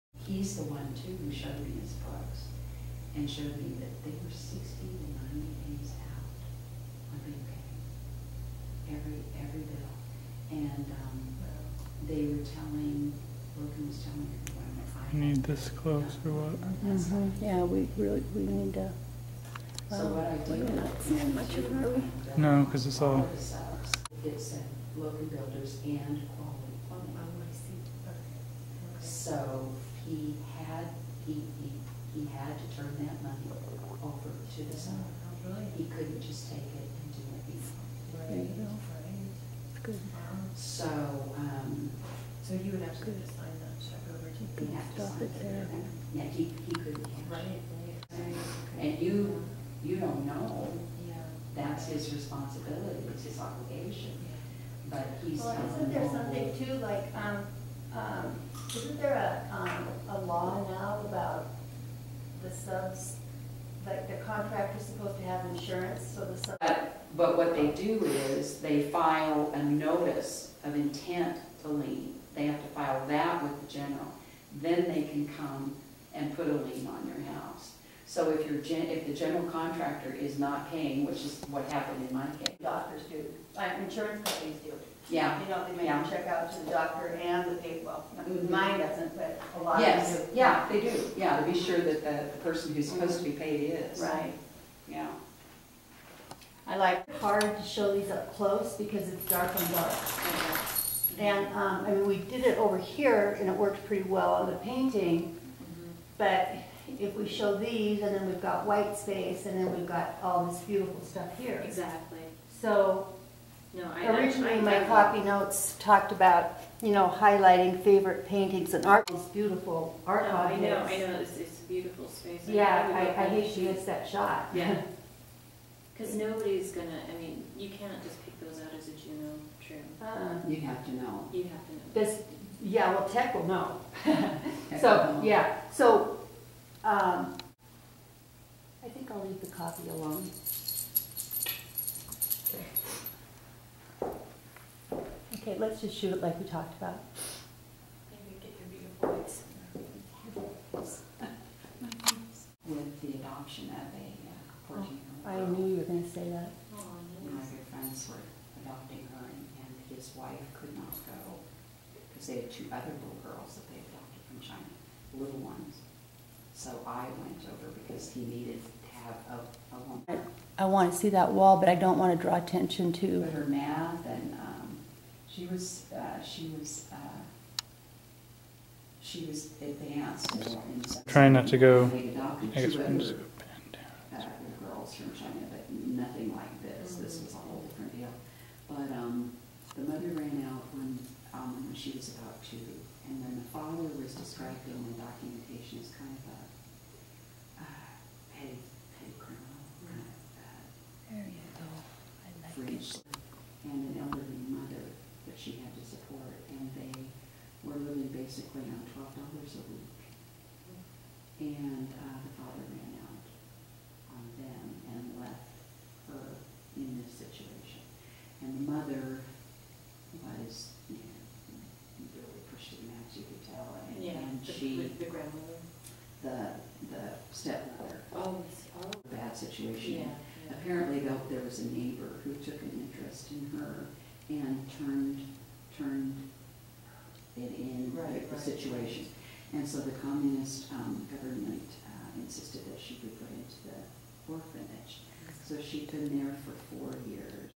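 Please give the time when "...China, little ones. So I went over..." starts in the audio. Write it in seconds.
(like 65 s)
164 s.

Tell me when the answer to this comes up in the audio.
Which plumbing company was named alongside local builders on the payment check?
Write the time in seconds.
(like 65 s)
26 s.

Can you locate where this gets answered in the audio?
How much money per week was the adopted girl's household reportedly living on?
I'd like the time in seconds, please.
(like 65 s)
208 s.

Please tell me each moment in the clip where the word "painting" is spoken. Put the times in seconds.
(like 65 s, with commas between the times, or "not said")
104 s, 118 s.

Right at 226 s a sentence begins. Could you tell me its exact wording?
the, the stepmother, Oh, oh, bad yeah, situation.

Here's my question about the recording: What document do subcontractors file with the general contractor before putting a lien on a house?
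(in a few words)
notice of intent to lien.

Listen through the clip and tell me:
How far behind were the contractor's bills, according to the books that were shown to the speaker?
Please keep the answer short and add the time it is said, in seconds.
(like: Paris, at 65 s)
60 to 90 days, at 4 s.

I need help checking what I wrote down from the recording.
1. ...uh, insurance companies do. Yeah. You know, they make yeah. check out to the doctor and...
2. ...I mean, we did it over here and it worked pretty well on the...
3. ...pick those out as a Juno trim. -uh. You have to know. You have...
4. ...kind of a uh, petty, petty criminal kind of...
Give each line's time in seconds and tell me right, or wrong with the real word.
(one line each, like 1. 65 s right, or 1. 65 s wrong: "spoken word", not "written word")
1. 83 s right
2. 101 s right
3. 128 s right
4. 195 s right.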